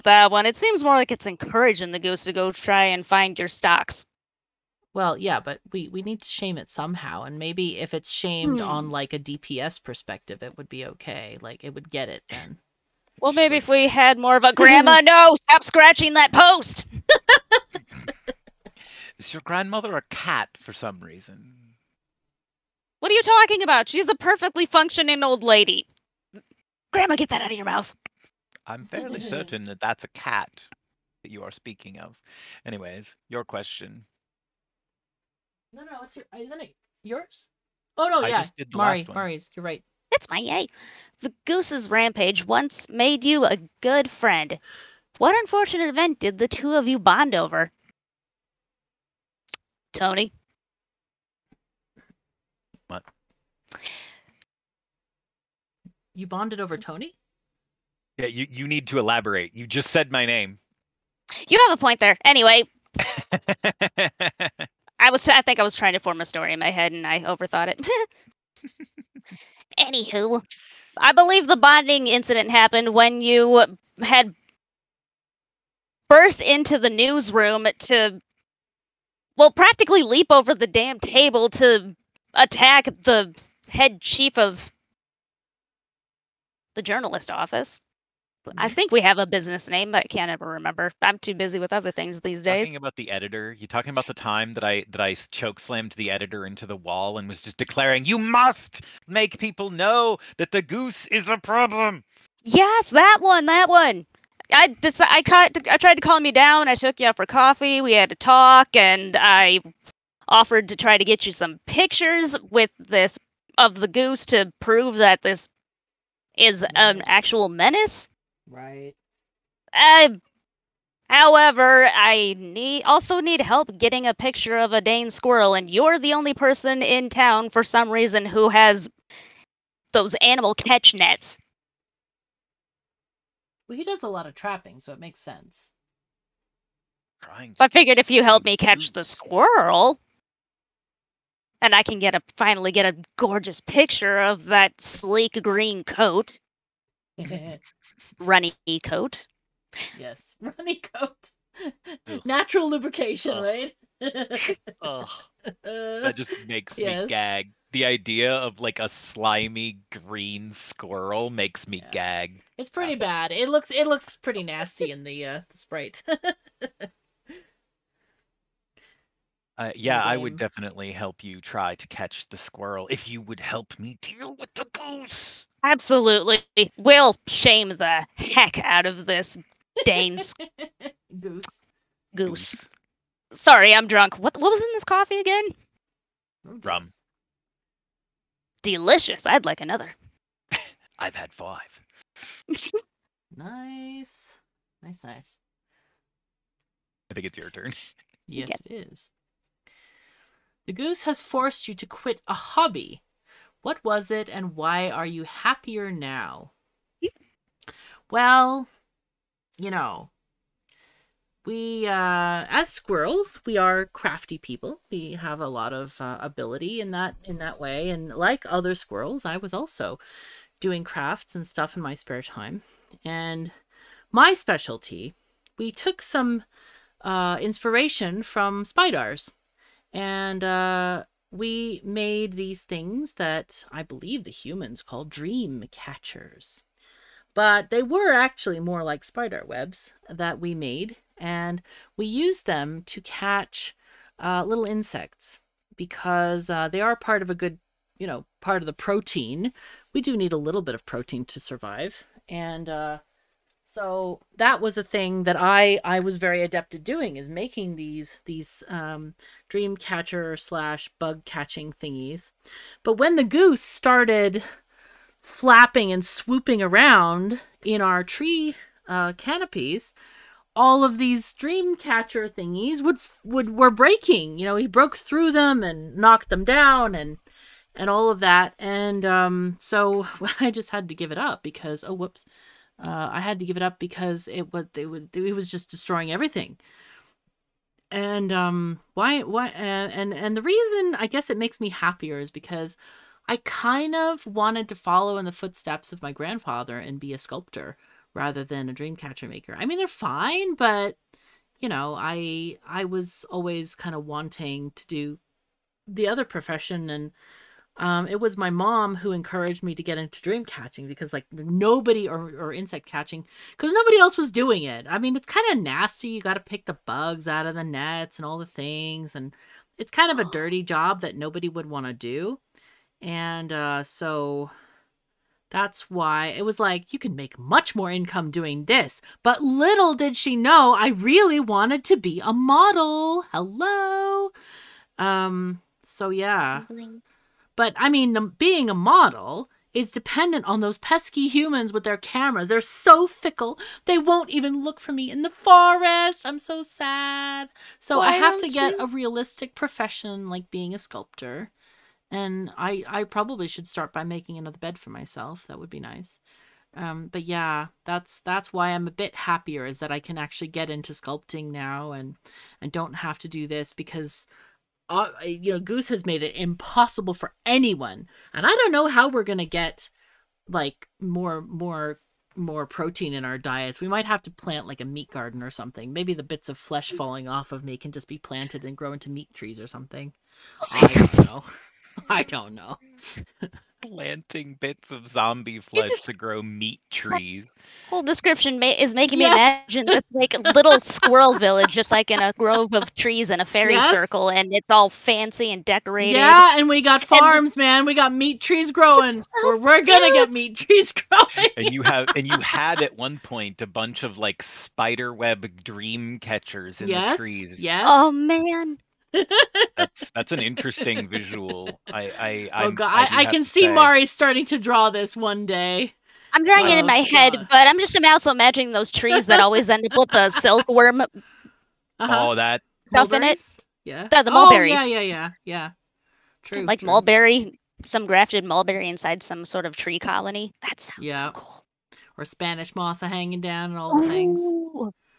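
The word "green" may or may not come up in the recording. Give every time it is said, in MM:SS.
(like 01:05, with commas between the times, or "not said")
02:25, 02:39.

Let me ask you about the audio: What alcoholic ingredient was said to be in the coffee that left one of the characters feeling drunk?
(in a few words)
Rum.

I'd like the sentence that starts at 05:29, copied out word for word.
But little did she know, I really wanted to be a model.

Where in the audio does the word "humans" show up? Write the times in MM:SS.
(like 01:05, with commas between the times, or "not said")
03:54, 05:41.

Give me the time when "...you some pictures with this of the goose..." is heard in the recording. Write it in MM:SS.
01:51.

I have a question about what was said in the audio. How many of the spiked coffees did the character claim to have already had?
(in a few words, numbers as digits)
5.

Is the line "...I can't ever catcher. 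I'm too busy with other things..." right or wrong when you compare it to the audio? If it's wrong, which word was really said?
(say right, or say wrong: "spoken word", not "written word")
wrong: "remember", not "catcher".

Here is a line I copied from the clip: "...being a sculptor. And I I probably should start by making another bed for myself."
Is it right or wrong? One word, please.
right.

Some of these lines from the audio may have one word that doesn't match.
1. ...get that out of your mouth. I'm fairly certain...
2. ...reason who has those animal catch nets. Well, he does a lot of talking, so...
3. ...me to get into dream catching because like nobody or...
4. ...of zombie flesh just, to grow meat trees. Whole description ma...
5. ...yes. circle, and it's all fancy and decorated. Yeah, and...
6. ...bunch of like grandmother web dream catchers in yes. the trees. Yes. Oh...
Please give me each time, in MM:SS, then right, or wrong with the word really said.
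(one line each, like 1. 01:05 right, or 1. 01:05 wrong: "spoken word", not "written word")
1. 00:27 right
2. 02:07 wrong: "trapping", not "talking"
3. 05:09 right
4. 06:24 right
5. 06:33 right
6. 06:43 wrong: "spider", not "grandmother".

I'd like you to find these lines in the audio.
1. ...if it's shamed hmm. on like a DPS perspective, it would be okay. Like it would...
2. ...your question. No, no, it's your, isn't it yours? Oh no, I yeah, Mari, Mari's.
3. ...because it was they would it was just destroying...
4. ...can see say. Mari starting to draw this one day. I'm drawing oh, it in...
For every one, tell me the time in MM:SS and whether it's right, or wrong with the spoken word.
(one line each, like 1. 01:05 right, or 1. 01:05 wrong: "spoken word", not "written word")
1. 00:07 right
2. 00:33 right
3. 04:43 right
4. 06:53 right.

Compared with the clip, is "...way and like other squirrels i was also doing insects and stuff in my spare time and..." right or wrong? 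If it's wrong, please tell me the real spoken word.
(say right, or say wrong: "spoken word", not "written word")
wrong: "crafts", not "insects".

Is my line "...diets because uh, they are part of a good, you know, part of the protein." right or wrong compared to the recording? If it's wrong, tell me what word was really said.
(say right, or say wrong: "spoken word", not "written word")
wrong: "insects", not "diets".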